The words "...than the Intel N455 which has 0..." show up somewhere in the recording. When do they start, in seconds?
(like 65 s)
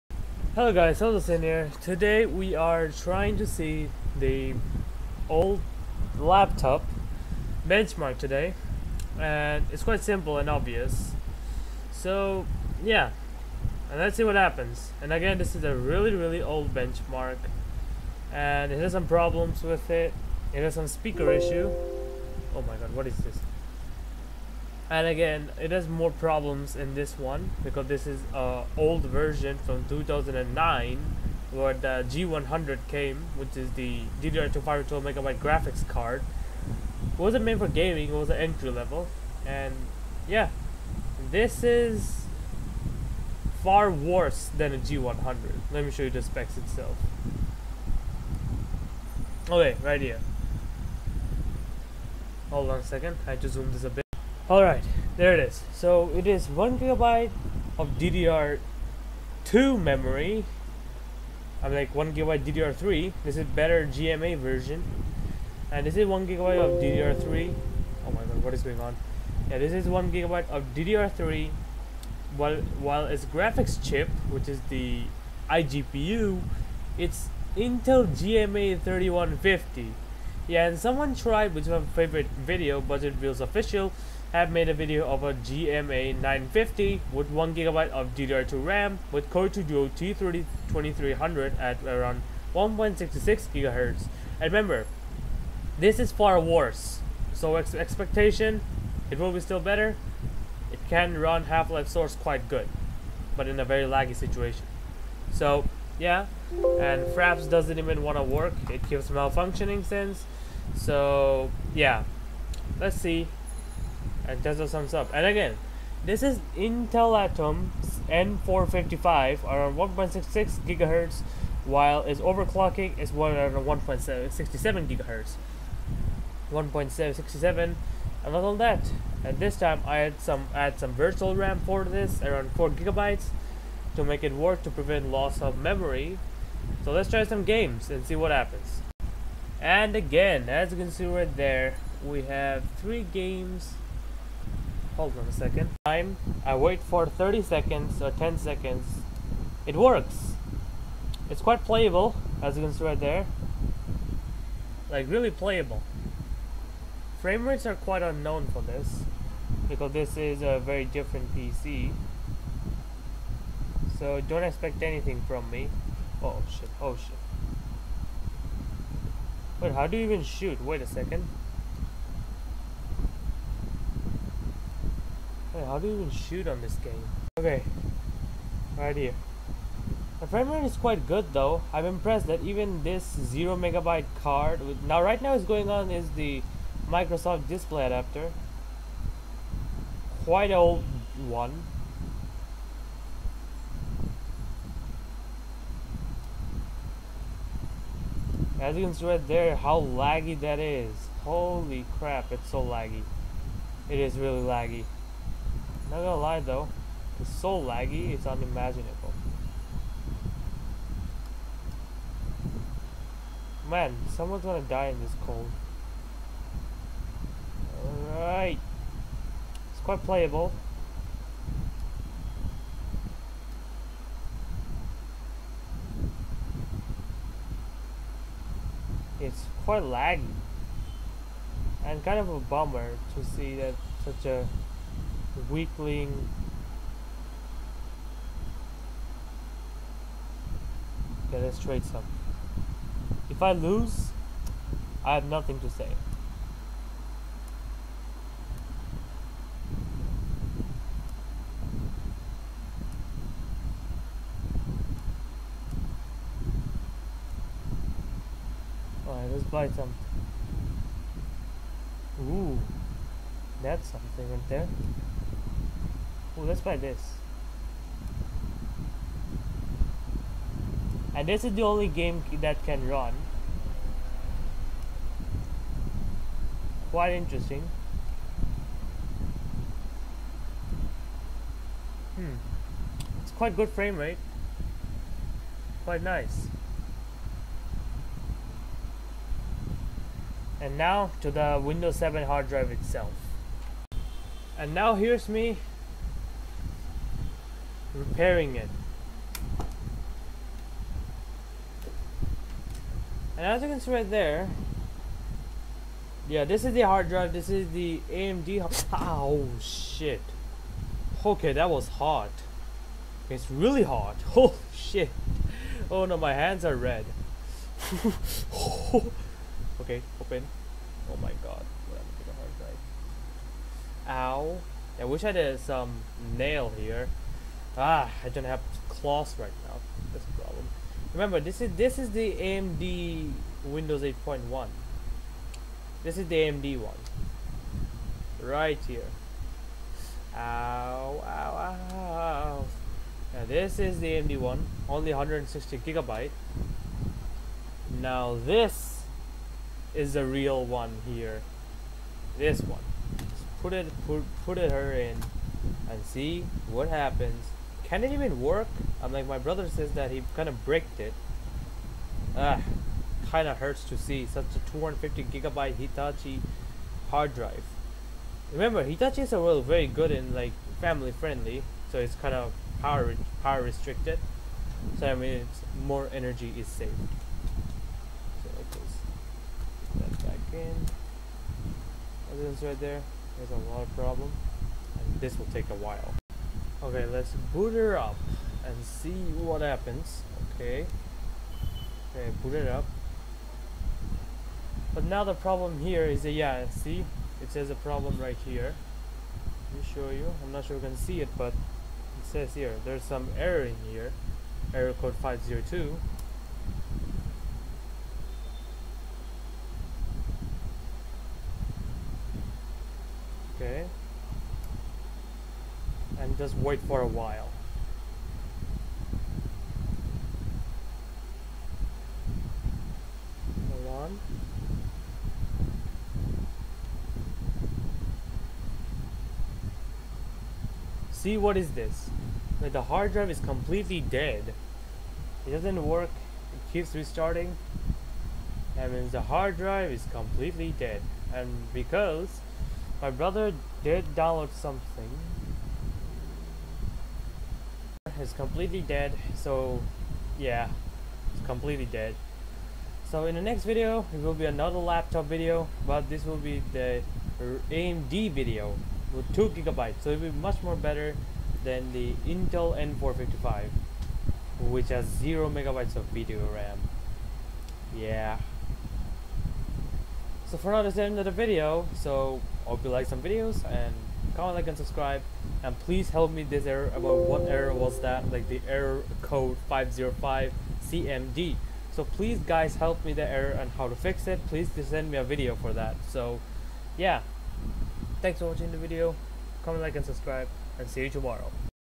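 461 s.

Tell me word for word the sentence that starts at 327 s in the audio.
Ah, I don't have claws right now.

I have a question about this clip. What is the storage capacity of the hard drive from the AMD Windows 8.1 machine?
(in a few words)
160 gigabytes.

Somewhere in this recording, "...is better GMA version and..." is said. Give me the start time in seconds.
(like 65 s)
63 s.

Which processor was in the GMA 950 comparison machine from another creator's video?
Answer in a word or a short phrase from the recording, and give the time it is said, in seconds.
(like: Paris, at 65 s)
Core 2 Duo T2300, at 89 s.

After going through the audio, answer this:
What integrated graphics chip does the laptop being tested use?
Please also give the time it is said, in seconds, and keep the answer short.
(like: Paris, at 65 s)
Intel GMA 3150, at 77 s.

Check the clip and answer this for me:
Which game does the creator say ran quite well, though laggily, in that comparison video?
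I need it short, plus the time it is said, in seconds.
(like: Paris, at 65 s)
Half-Life Source, at 101 s.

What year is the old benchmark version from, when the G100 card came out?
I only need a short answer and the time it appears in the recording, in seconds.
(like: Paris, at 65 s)
2009, at 29 s.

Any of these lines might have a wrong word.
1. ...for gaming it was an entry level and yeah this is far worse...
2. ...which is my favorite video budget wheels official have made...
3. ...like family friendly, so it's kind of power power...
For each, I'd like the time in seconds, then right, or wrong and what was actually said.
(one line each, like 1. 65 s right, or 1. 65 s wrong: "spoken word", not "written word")
1. 37 s right
2. 81 s right
3. 370 s right.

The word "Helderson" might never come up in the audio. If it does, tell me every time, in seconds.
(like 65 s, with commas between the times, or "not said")
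0 s.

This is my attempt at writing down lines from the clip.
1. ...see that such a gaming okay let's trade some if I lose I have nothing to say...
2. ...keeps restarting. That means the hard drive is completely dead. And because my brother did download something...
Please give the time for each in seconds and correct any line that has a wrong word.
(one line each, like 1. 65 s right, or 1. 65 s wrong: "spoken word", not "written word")
1. 233 s wrong: "weakling", not "gaming"
2. 436 s right.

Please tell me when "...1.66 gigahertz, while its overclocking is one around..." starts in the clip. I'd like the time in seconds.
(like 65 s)
119 s.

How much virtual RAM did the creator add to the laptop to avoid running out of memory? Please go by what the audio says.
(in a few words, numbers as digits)
4 gigabytes.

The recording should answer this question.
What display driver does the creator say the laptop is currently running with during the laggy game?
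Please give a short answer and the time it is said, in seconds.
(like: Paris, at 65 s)
Microsoft display adapter, at 186 s.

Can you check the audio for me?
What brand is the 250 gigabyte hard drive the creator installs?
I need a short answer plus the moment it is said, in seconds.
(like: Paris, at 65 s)
Hitachi, at 365 s.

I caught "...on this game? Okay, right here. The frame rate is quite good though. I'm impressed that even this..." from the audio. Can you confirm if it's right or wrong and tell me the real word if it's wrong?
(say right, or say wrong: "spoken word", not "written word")
right.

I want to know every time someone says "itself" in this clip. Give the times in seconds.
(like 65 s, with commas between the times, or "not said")
46 s, 292 s.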